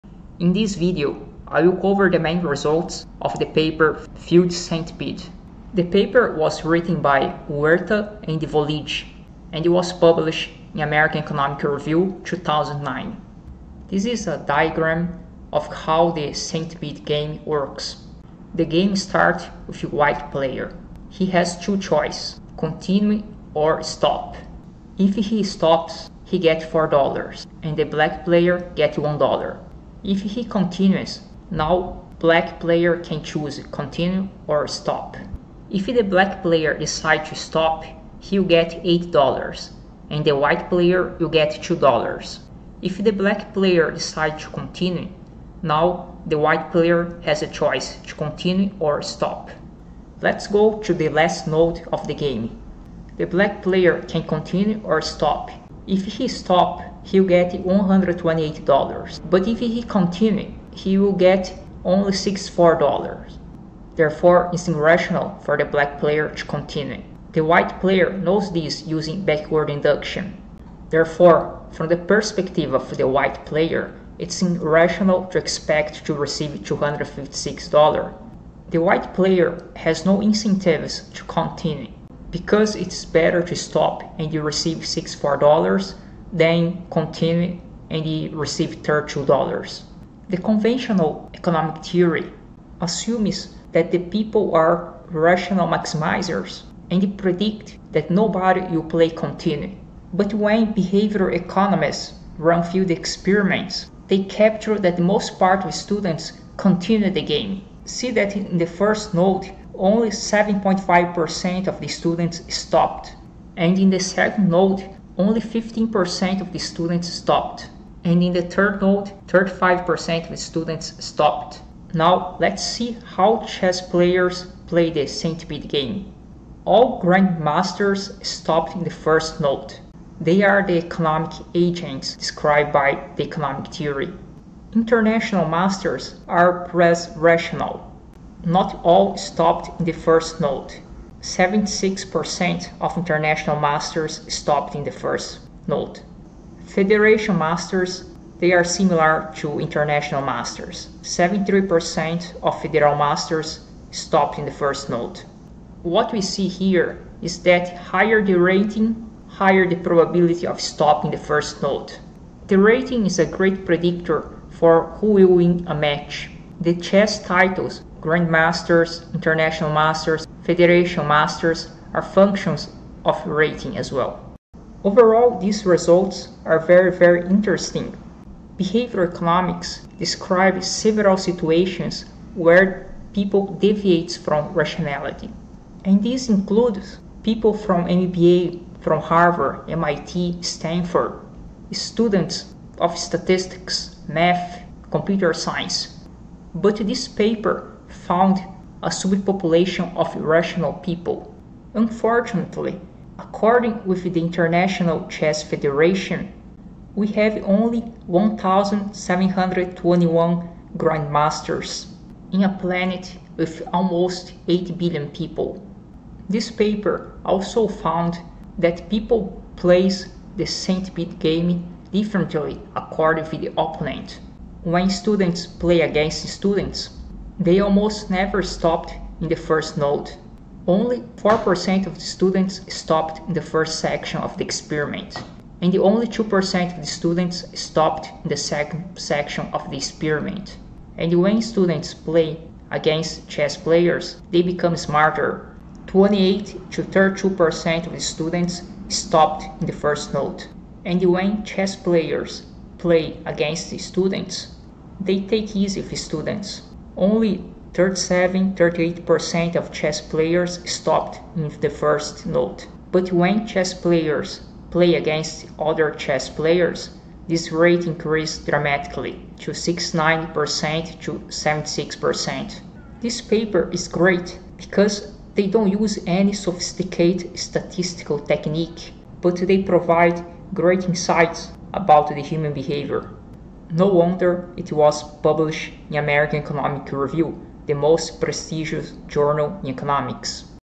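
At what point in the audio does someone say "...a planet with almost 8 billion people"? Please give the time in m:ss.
3:32.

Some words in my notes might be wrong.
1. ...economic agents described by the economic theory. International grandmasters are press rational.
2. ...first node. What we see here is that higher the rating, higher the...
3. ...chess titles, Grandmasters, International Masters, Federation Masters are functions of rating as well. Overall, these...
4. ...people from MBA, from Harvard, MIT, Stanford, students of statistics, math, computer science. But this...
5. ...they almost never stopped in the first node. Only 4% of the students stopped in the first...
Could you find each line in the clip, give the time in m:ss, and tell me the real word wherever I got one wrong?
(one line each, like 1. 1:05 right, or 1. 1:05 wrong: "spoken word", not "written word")
1. 2:10 wrong: "masters", not "grandmasters"
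2. 2:34 right
3. 2:46 right
4. 3:07 right
5. 3:47 right.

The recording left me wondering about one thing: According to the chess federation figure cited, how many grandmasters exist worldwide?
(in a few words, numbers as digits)
1,721.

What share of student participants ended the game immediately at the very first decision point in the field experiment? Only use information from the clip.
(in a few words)
7.5%.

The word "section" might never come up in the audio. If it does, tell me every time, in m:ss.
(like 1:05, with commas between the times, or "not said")
3:53, 3:58.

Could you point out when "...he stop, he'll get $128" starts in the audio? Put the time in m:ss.
0:56.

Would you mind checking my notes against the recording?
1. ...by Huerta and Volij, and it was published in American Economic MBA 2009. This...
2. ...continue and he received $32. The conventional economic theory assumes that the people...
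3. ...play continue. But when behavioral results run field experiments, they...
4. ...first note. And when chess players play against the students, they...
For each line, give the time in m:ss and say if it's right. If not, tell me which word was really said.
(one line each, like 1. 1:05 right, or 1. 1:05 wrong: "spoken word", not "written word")
1. 0:06 wrong: "Review", not "MBA"
2. 1:26 right
3. 1:38 wrong: "economists", not "results"
4. 4:09 right.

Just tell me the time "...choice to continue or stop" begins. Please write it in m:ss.
0:47.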